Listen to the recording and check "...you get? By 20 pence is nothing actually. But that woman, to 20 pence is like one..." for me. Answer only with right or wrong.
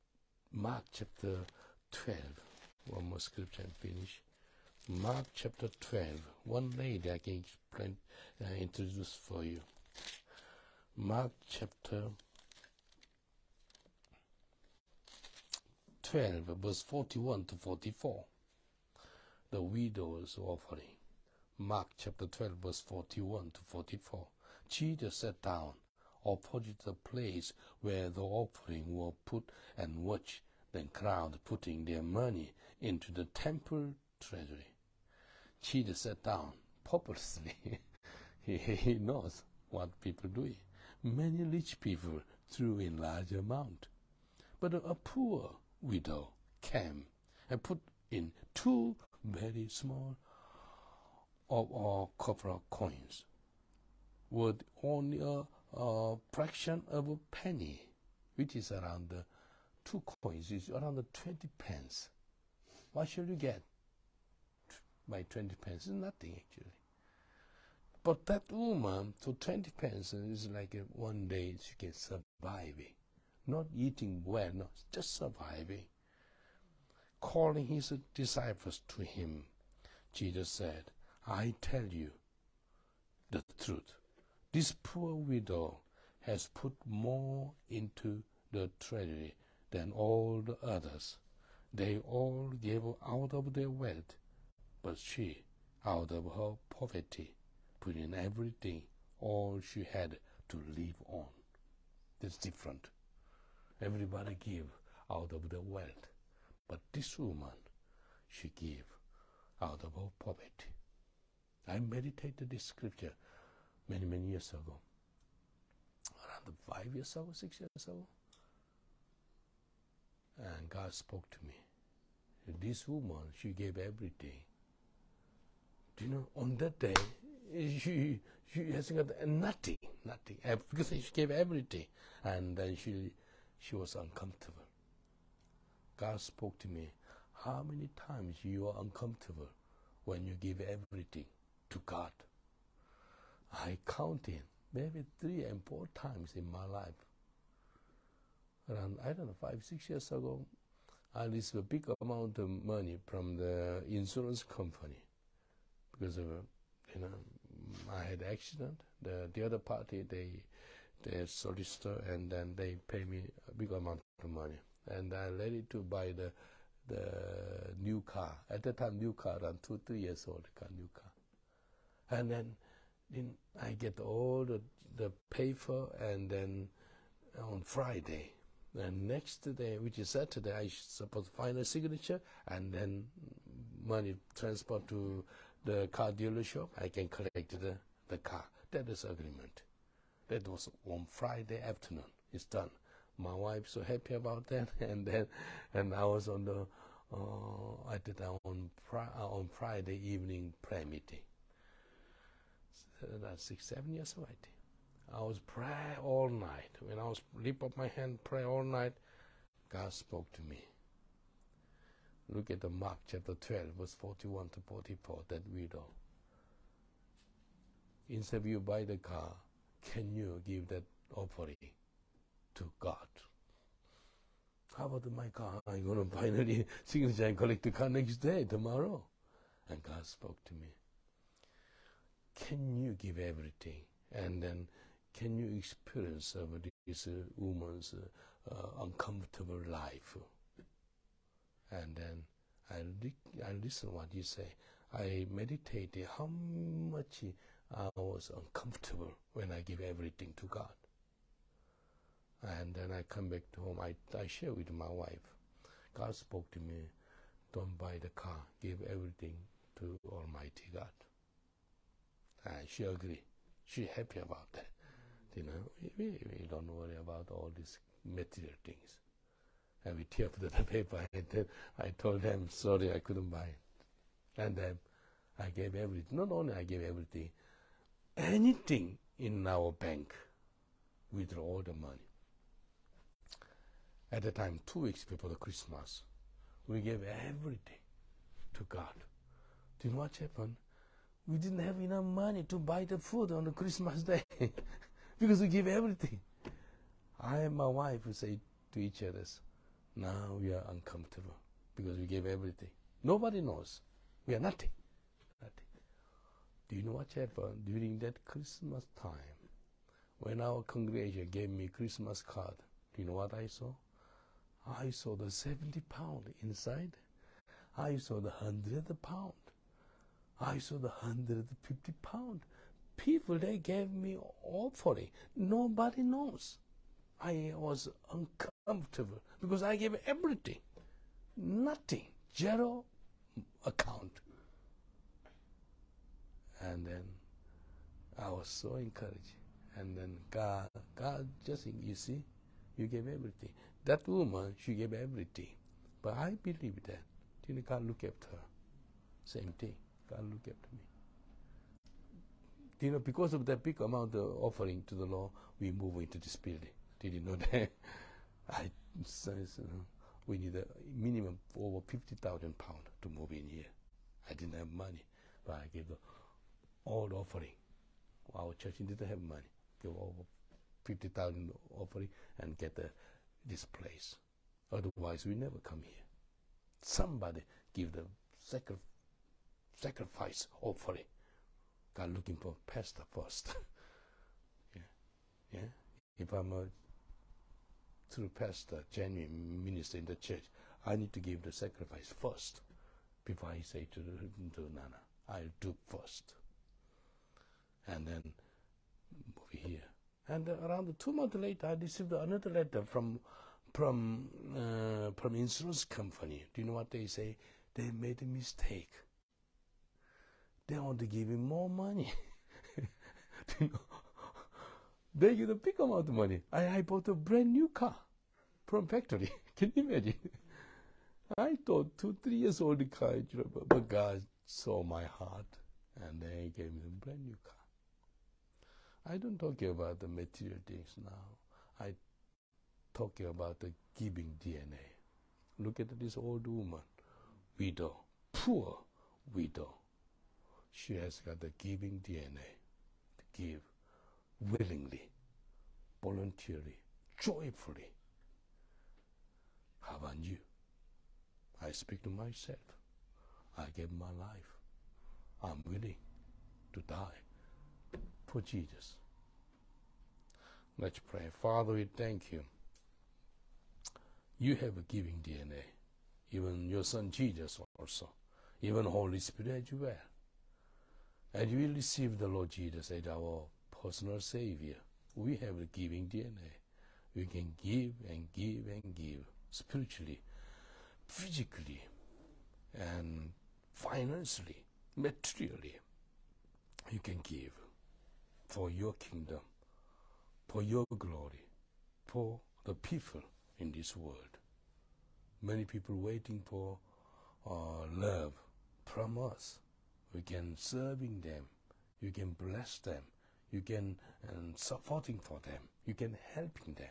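right.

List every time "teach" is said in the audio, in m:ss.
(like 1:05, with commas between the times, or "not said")
not said.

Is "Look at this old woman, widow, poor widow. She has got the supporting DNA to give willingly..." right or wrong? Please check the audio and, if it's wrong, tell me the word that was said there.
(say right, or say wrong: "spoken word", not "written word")
wrong: "giving", not "supporting".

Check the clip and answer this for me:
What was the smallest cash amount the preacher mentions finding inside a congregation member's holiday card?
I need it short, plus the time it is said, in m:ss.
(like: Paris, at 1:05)
70 pound, at 5:15.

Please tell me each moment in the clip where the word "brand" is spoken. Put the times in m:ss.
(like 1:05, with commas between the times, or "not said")
6:57, 7:07.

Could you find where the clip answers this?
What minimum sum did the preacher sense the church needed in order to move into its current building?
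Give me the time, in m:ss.
6:01.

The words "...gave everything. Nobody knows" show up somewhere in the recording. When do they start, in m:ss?
5:02.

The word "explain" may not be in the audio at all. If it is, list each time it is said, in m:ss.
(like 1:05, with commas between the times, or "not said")
0:07.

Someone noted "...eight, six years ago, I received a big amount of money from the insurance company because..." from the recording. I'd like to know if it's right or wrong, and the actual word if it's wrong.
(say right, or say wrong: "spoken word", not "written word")
wrong: "five", not "eight".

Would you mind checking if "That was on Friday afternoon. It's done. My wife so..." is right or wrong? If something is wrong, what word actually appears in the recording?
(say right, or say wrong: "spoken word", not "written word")
right.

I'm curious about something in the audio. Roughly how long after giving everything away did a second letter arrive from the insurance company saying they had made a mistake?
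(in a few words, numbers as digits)
two months.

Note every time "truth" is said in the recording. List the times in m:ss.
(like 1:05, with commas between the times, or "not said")
1:23.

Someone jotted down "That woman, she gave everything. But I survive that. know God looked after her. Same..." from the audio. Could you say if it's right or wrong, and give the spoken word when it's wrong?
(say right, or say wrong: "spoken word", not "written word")
wrong: "believe", not "survive".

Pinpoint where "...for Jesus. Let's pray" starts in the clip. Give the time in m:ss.
7:38.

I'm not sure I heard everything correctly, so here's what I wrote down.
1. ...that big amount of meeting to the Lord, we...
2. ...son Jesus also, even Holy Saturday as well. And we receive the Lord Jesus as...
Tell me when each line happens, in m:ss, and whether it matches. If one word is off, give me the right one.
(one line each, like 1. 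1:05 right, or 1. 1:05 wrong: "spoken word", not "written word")
1. 5:53 wrong: "offering", not "meeting"
2. 7:46 wrong: "Spirit", not "Saturday".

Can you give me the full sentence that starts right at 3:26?
When I was lift up my hand, pray all night, God spoke to me.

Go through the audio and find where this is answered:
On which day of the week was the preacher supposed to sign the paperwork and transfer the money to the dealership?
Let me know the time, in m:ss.
3:00.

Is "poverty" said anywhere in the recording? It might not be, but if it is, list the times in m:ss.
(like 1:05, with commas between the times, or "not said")
1:36, 1:50.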